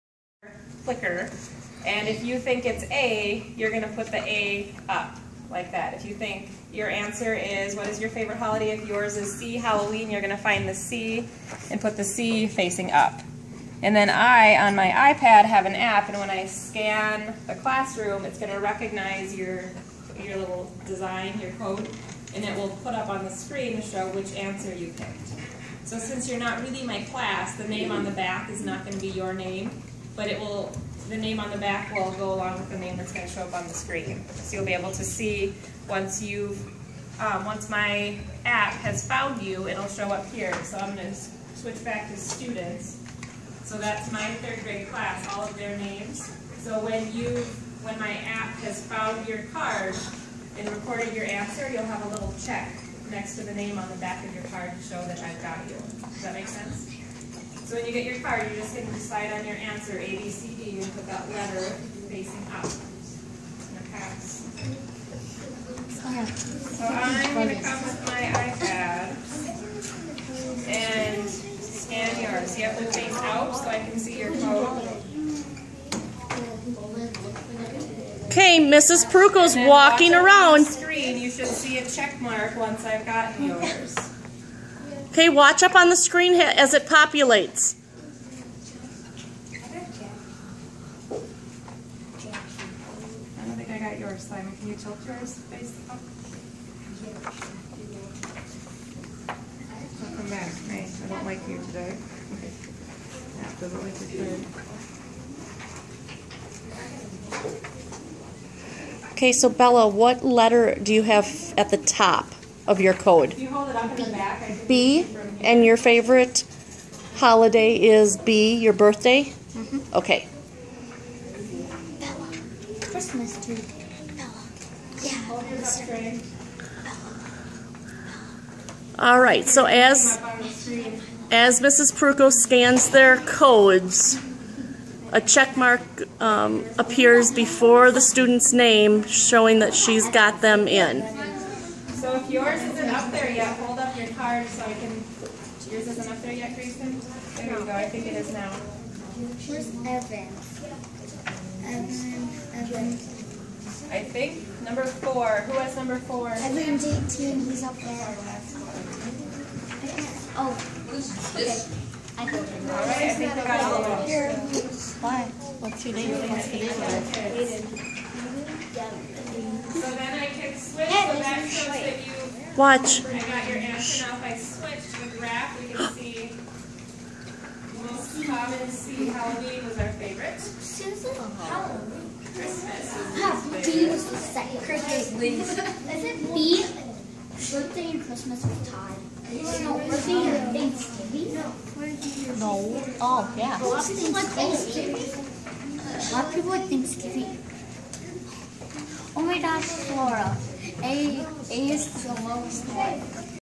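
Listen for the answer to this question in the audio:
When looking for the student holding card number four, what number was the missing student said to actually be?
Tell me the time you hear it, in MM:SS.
02:37.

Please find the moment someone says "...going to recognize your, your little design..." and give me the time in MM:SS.
00:18.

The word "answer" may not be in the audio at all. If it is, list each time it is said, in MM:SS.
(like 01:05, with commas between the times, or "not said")
00:06, 00:24, 00:51, 00:59, 02:53.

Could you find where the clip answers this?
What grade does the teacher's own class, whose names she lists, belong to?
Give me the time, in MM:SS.
00:44.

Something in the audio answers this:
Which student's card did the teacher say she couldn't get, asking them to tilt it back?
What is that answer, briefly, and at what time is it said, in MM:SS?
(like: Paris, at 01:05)
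Simon, at 01:34.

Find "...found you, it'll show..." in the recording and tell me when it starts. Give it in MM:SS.
00:39.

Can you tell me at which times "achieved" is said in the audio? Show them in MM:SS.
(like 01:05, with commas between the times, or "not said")
not said.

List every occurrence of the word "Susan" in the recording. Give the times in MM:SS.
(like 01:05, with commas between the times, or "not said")
03:00.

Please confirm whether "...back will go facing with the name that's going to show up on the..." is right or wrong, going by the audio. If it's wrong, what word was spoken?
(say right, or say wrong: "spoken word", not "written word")
wrong: "along", not "facing".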